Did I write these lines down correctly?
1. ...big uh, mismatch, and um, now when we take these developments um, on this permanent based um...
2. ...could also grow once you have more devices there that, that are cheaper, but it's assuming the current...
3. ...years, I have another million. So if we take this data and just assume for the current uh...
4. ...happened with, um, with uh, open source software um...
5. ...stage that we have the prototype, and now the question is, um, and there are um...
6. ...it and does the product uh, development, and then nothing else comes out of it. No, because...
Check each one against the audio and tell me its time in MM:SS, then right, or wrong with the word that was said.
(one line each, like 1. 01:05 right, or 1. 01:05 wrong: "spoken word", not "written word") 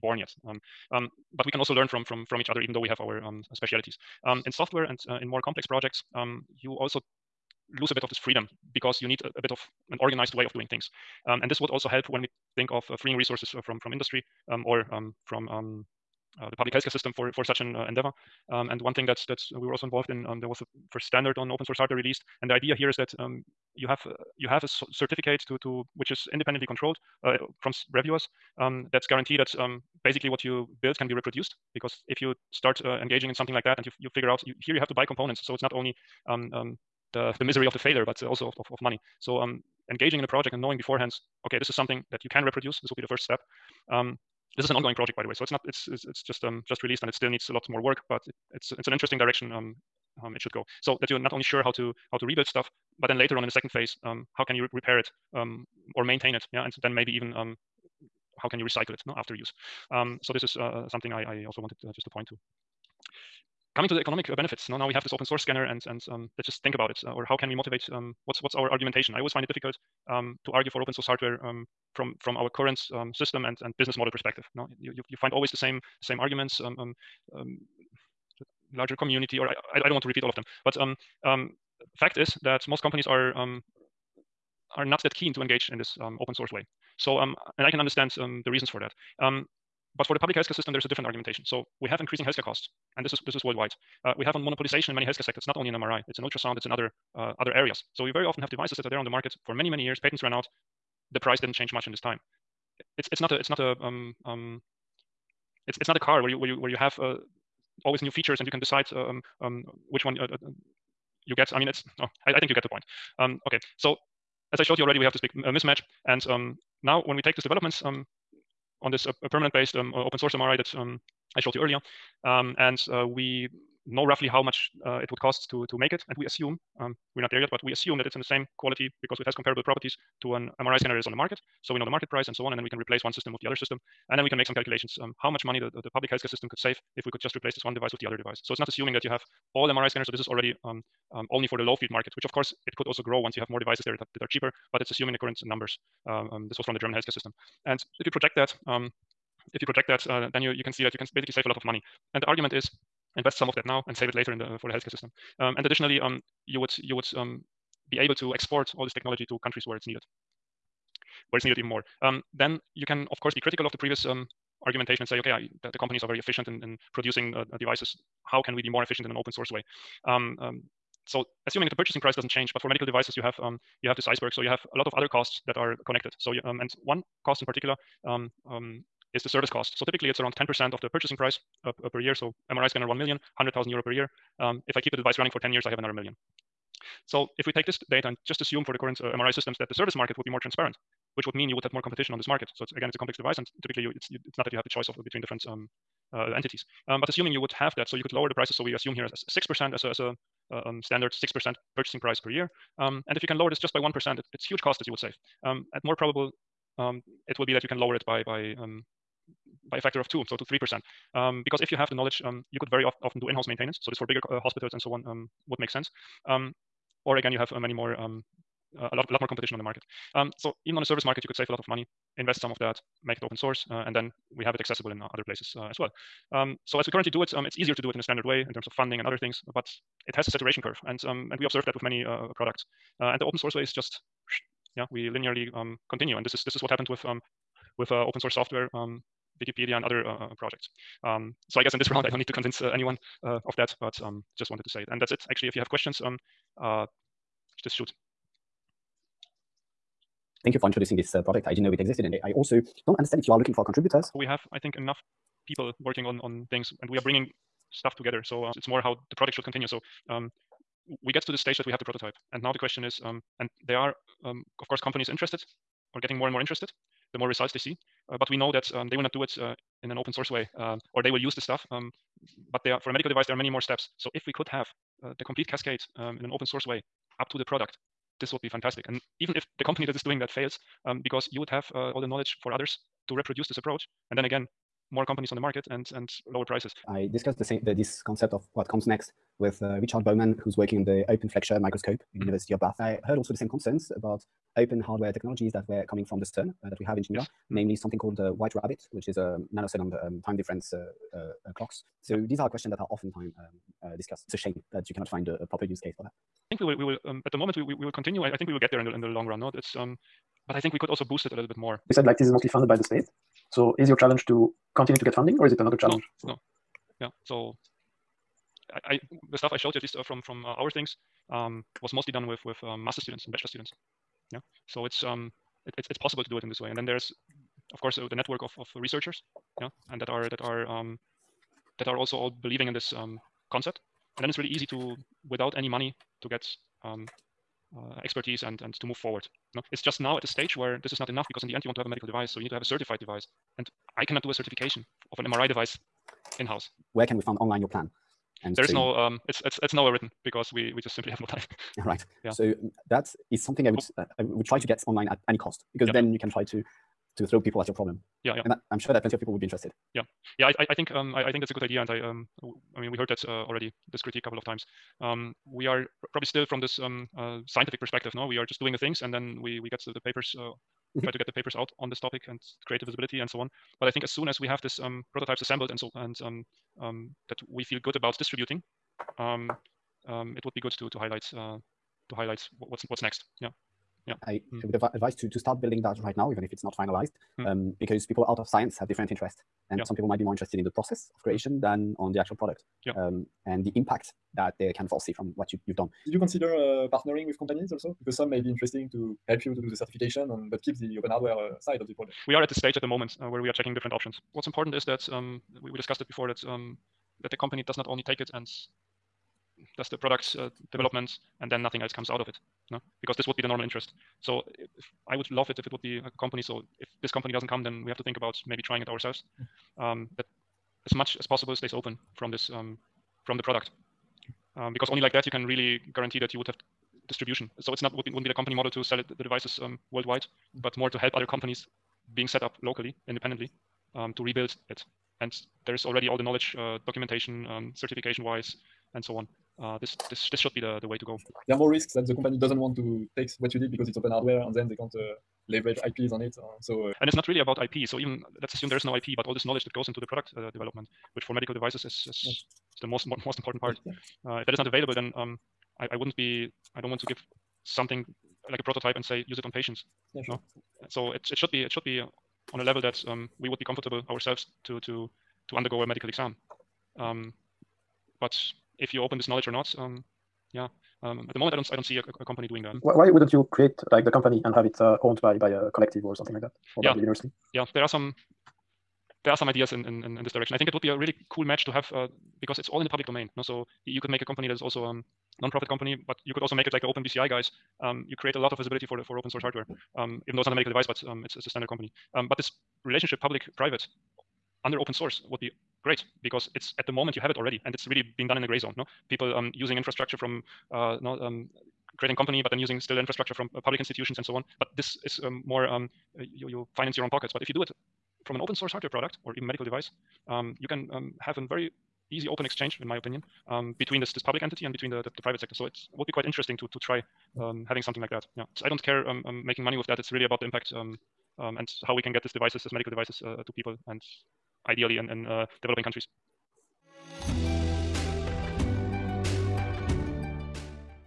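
1. 01:55 right
2. 02:22 right
3. 03:05 right
4. 03:56 right
5. 04:21 right
6. 06:48 right.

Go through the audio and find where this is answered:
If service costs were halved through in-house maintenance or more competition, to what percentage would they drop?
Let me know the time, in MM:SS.
03:30.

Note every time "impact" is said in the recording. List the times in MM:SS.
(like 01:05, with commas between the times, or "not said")
06:33, 08:40.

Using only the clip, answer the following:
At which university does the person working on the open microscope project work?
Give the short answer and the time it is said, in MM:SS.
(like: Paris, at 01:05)
University of Bath, at 04:52.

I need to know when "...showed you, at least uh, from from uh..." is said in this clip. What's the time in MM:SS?
05:19.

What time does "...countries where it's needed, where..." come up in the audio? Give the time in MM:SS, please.
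02:39.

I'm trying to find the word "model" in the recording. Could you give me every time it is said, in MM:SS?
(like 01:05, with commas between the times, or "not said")
01:13, 07:08.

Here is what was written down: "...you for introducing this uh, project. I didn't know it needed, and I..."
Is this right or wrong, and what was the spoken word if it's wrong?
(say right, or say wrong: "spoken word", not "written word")
wrong: "existed", not "needed".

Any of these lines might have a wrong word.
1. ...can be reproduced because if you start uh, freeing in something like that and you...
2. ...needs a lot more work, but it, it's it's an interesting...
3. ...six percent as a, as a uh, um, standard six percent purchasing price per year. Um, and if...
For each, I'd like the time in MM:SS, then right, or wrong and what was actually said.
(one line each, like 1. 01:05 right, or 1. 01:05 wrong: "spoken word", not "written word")
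1. 00:30 wrong: "engaging", not "freeing"
2. 00:47 right
3. 03:19 right.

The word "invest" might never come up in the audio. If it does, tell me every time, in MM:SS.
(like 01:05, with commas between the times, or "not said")
02:33, 03:42.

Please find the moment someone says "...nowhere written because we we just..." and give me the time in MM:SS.
05:49.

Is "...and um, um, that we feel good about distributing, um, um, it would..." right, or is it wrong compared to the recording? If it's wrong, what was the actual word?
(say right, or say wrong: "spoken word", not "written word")
right.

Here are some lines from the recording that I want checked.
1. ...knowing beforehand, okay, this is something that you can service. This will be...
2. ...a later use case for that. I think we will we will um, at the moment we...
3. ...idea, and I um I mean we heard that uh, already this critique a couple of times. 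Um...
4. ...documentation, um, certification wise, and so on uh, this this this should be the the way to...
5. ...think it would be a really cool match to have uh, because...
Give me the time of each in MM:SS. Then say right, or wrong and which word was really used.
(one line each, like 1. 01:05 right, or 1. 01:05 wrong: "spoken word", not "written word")
1. 00:40 wrong: "reproduce", not "service"
2. 05:05 wrong: "proper", not "later"
3. 06:01 right
4. 07:16 right
5. 08:00 right.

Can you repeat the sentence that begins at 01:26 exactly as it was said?
So, um, and I can understand um, the reasons for that.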